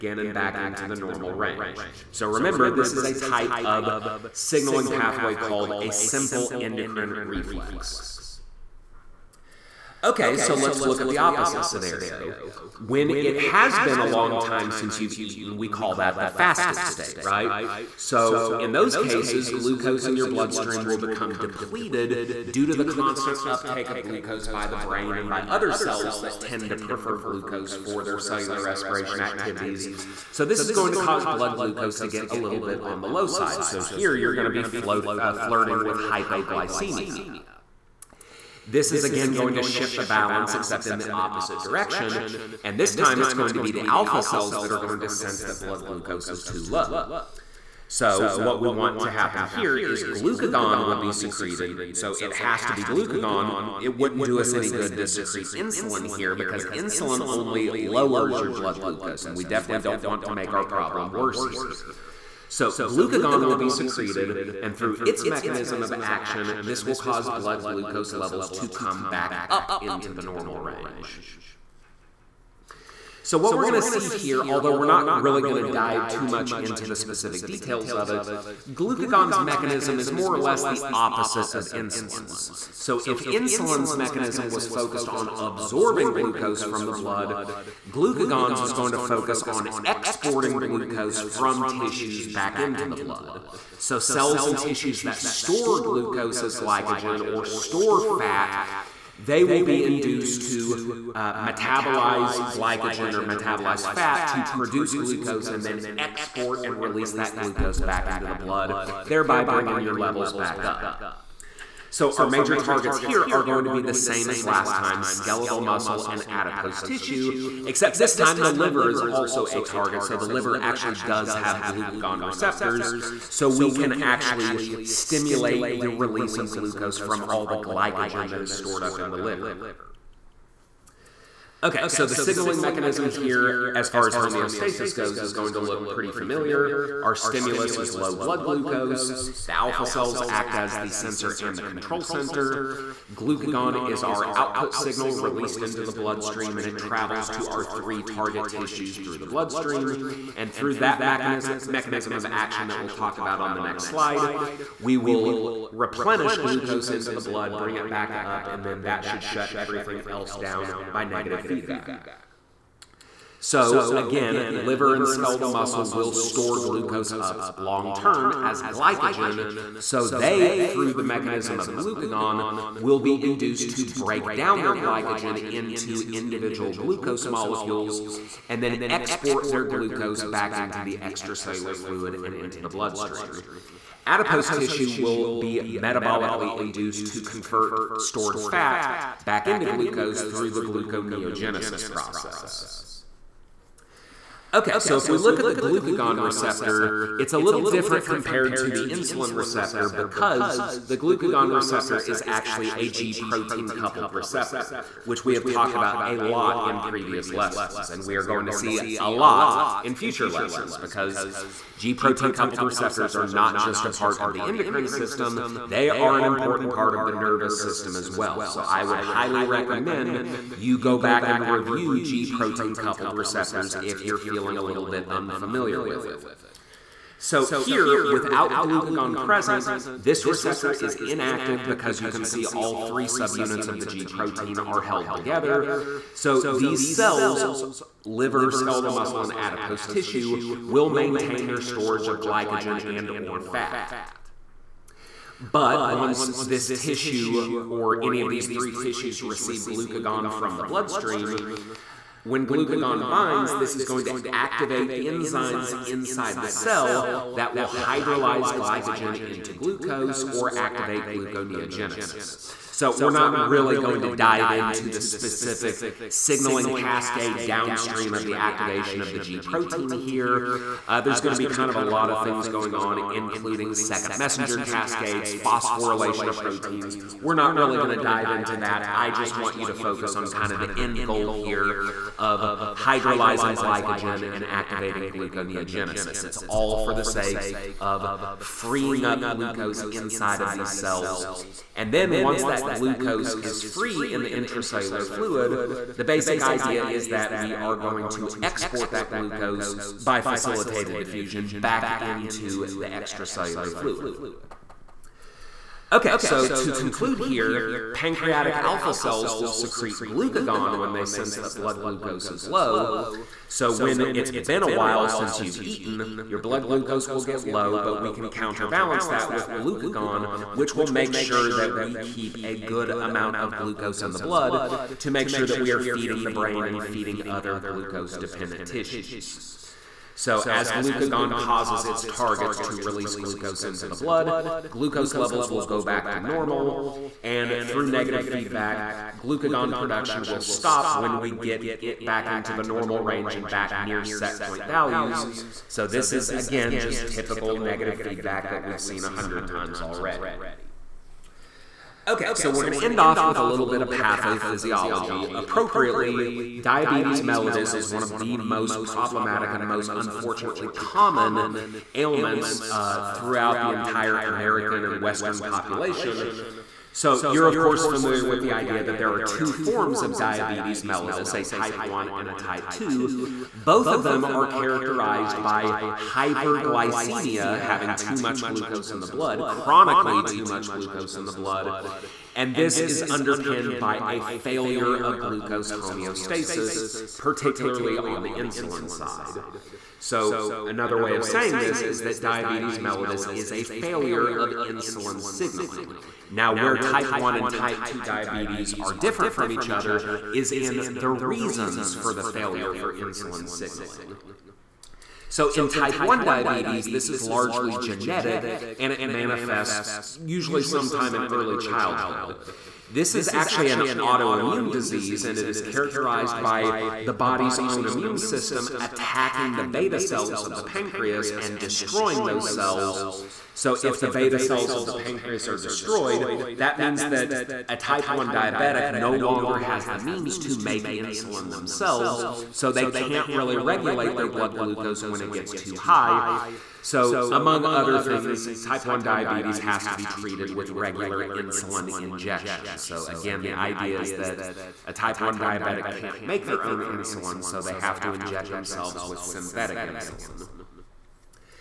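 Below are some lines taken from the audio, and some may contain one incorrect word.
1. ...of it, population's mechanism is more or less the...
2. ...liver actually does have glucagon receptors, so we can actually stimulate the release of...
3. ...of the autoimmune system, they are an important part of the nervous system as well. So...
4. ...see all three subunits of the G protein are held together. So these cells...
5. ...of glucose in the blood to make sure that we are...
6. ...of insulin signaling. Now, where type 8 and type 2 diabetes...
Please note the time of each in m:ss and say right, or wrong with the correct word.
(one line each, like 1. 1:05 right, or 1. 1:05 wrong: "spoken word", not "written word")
1. 1:17 wrong: "glucagon", not "population"
2. 2:00 right
3. 3:34 wrong: "endocrine", not "autoimmune"
4. 3:52 right
5. 5:23 right
6. 6:34 wrong: "1", not "8".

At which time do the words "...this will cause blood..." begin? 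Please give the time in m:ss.
1:06.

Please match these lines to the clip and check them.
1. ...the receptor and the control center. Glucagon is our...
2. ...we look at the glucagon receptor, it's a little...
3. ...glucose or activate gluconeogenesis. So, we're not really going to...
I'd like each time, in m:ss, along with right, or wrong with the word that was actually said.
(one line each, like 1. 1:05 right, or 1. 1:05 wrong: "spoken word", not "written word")
1. 2:20 wrong: "sensor", not "receptor"
2. 3:15 right
3. 4:19 right.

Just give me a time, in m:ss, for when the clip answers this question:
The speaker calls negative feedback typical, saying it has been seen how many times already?
5:49.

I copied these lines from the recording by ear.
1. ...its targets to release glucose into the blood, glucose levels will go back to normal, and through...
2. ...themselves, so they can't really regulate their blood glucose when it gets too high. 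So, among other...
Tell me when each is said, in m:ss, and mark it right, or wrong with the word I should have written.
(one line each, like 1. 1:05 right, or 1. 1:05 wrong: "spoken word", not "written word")
1. 5:31 right
2. 7:11 right.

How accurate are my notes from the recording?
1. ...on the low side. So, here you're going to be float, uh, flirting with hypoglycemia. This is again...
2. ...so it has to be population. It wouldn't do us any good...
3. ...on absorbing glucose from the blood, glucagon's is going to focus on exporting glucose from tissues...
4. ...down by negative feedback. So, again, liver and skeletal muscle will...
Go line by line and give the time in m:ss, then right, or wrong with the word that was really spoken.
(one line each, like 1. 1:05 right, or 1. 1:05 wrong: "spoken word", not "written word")
1. 0:32 right
2. 0:51 wrong: "glucagon", not "population"
3. 1:25 right
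4. 2:40 right.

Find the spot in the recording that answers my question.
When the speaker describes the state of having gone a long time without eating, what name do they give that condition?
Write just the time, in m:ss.
0:16.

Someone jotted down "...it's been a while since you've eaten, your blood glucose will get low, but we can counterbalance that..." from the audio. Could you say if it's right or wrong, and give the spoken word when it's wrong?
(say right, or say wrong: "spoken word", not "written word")
right.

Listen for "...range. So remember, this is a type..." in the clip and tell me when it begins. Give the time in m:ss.
0:01.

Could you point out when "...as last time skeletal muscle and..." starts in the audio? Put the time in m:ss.
1:54.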